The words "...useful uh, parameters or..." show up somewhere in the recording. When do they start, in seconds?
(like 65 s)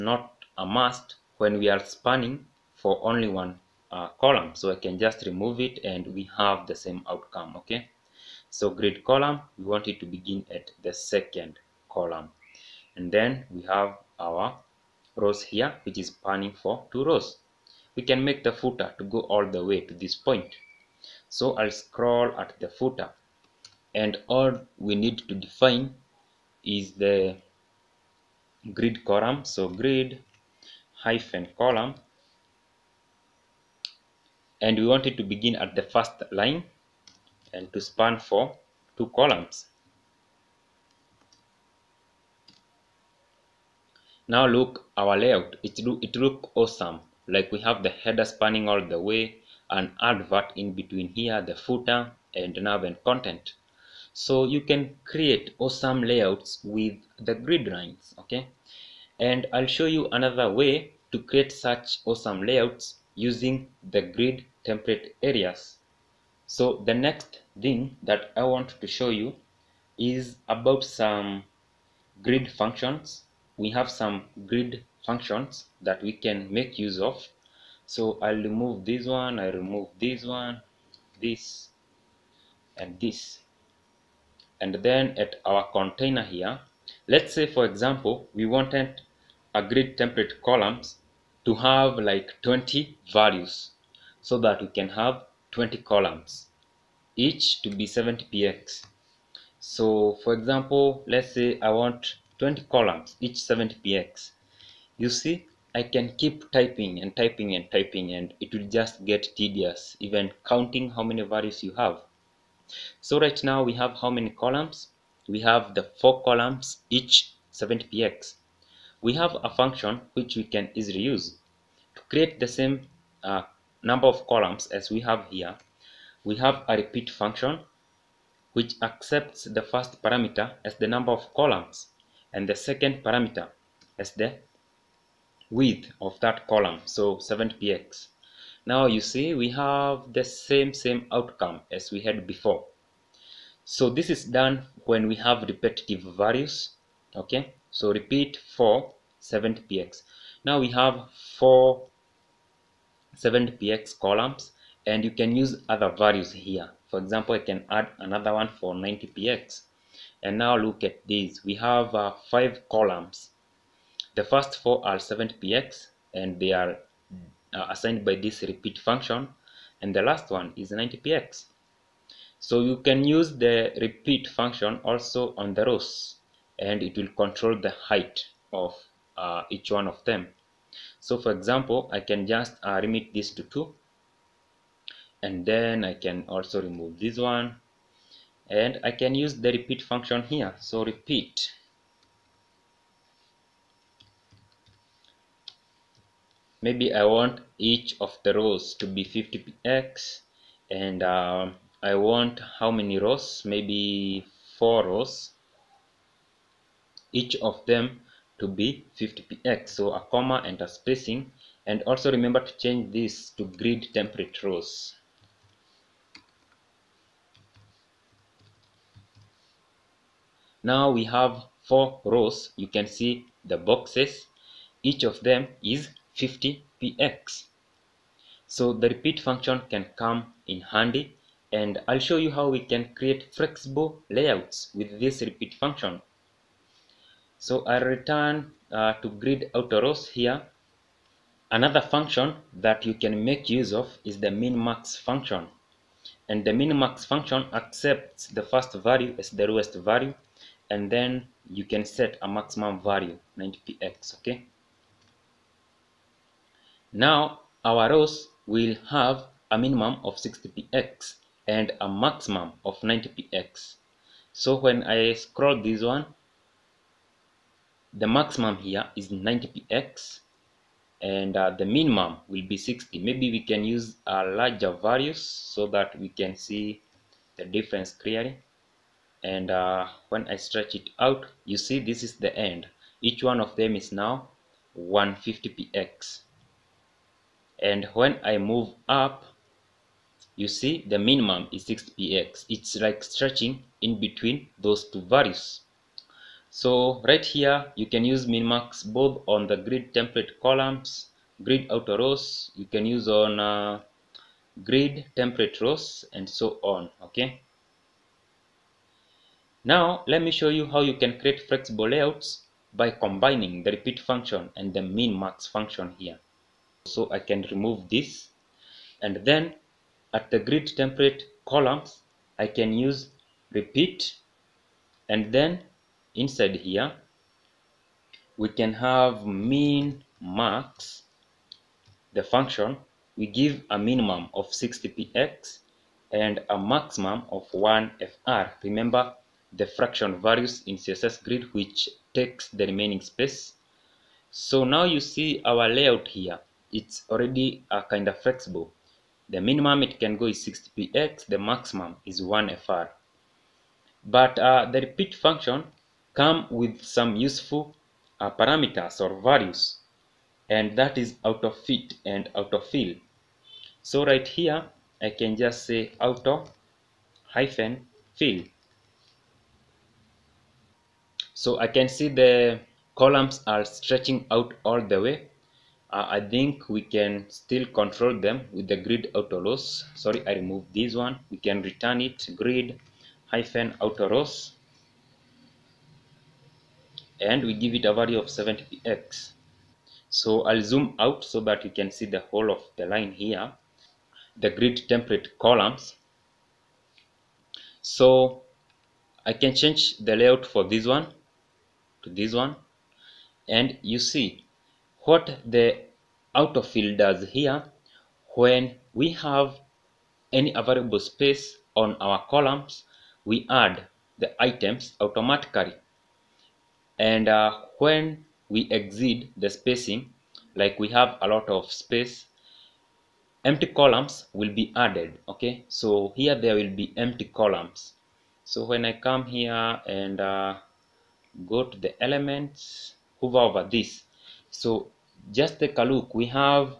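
357 s.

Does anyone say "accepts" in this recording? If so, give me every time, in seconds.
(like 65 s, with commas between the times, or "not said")
128 s, 247 s.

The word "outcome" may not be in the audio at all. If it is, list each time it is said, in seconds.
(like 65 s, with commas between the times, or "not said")
7 s, 141 s.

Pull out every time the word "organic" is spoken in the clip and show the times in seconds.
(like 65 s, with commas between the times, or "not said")
not said.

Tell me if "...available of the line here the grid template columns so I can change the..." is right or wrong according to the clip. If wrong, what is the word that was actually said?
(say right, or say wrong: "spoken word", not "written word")
wrong: "whole", not "available".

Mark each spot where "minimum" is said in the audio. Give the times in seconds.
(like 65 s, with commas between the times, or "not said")
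259 s, 271 s, 290 s, 333 s, 349 s.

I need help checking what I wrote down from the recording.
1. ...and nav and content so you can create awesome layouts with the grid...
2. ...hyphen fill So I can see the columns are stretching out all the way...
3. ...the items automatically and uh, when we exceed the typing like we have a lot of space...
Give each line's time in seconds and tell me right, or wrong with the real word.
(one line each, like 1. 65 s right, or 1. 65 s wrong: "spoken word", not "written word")
1. 52 s right
2. 367 s right
3. 414 s wrong: "spacing", not "typing".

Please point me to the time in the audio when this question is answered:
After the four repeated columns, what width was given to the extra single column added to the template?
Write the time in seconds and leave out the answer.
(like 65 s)
157 s.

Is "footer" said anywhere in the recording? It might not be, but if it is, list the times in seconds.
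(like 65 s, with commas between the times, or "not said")
18 s, 22 s, 51 s.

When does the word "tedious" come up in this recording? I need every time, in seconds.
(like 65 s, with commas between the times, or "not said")
109 s.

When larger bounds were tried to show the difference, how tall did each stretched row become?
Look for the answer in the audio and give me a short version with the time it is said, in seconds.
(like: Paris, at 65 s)
150px, at 284 s.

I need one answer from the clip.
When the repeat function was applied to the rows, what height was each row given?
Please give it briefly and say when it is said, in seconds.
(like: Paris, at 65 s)
50px, at 197 s.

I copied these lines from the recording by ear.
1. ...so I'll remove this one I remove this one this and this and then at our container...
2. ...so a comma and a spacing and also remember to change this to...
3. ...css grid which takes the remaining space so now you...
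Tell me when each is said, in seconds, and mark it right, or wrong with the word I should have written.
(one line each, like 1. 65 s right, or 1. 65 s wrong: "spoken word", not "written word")
1. 77 s right
2. 209 s right
3. 340 s right.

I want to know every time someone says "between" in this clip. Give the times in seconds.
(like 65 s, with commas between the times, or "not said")
50 s, 293 s.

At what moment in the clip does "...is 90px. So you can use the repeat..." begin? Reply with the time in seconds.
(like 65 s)
170 s.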